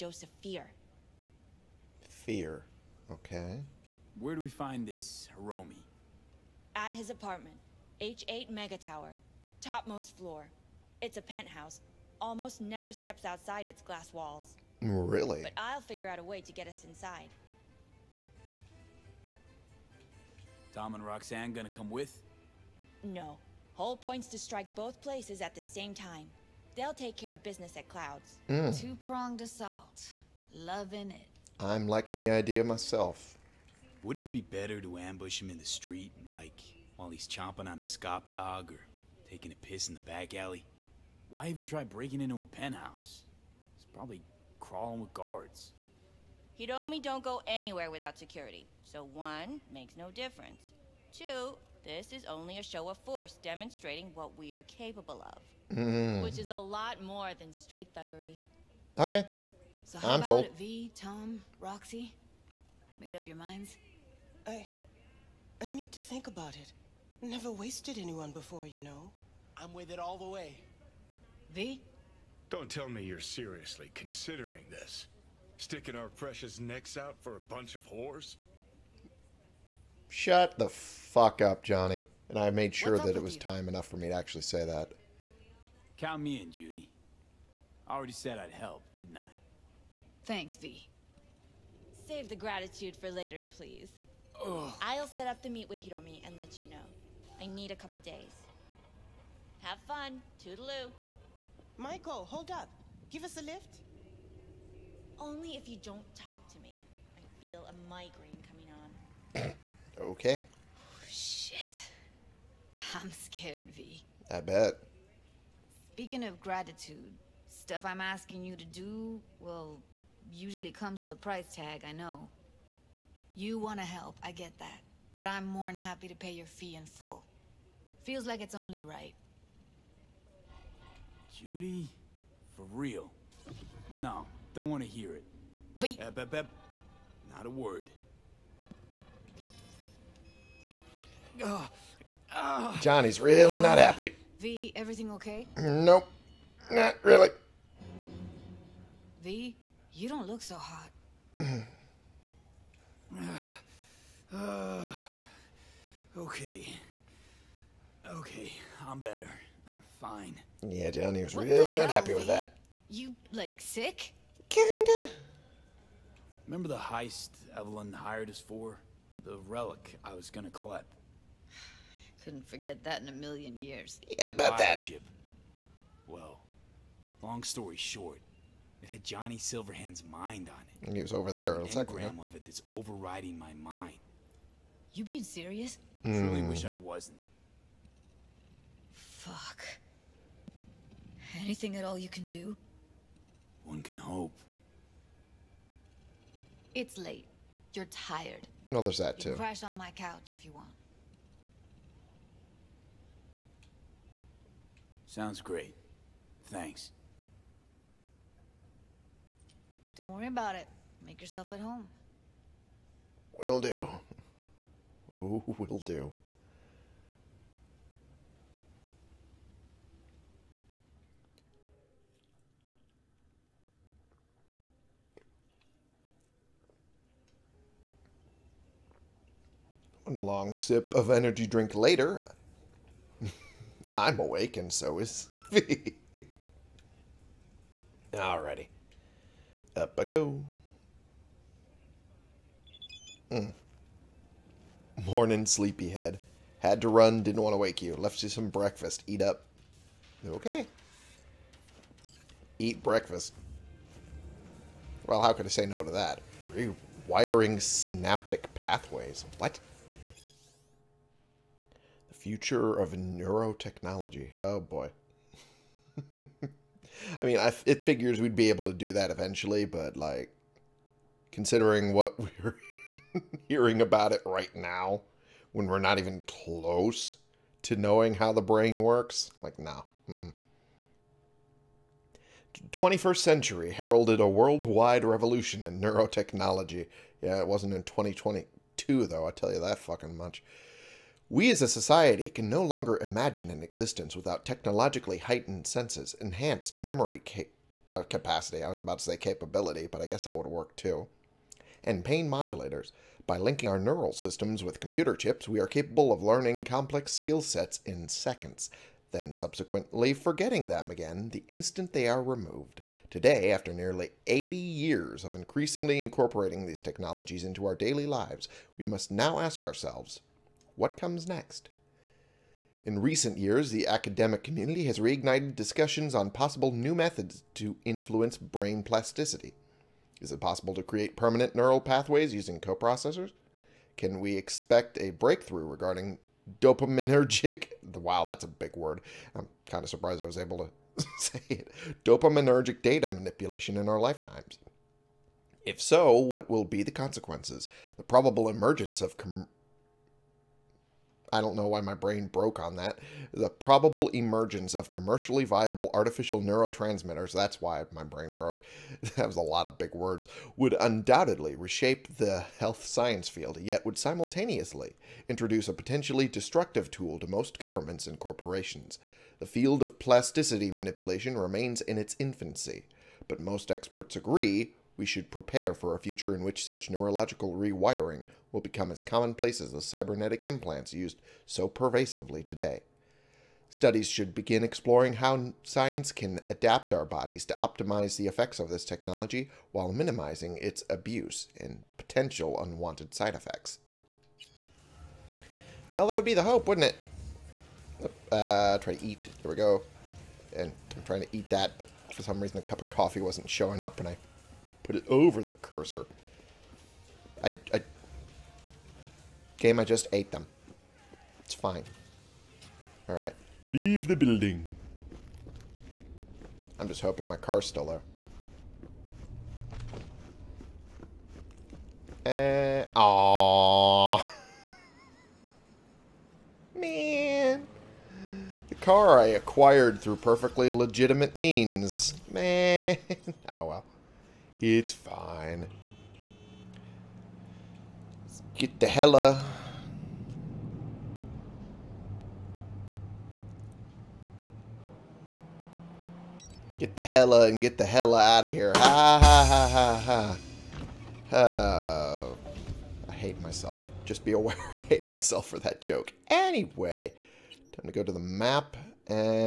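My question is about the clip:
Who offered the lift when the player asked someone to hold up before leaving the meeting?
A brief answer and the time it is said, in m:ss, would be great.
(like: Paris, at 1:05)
Maiko, at 1:41.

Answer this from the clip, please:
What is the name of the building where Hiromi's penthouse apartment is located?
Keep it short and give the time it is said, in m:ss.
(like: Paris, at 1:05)
H8 Mega Tower, at 0:08.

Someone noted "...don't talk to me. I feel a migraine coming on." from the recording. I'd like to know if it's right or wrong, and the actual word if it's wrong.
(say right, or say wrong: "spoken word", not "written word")
right.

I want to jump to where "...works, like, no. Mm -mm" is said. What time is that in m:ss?
4:38.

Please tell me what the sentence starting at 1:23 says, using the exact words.
time enough for me to actually say that.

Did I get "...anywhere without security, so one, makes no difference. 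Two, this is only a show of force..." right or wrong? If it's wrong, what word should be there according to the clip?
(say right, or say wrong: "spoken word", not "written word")
right.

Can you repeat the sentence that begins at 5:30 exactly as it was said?
Is it possible to create permanent neural pathways using coprocessors?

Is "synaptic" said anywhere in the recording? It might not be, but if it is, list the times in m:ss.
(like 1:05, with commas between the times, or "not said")
4:17.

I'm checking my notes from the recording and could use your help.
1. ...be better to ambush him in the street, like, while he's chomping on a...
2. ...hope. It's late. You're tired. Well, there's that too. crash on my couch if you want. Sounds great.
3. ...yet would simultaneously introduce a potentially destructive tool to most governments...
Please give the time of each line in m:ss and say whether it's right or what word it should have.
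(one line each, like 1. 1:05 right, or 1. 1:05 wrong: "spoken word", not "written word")
1. 0:34 right
2. 3:13 right
3. 6:03 right.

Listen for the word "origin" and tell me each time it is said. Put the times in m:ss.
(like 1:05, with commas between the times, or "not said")
not said.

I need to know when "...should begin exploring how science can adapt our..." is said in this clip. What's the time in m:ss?
6:24.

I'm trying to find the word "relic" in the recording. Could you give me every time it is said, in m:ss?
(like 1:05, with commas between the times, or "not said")
2:49.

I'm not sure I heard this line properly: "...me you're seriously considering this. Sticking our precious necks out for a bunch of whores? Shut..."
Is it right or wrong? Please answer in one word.
right.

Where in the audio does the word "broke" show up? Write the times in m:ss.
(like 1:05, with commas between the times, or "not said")
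5:52, 5:58.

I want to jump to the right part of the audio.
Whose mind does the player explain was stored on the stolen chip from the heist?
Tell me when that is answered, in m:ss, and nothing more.
2:59.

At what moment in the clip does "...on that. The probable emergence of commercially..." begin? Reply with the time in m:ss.
5:52.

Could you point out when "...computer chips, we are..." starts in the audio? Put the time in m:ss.
5:04.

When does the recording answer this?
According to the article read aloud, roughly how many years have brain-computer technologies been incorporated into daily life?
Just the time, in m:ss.
5:14.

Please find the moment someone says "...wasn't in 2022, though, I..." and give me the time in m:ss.
4:47.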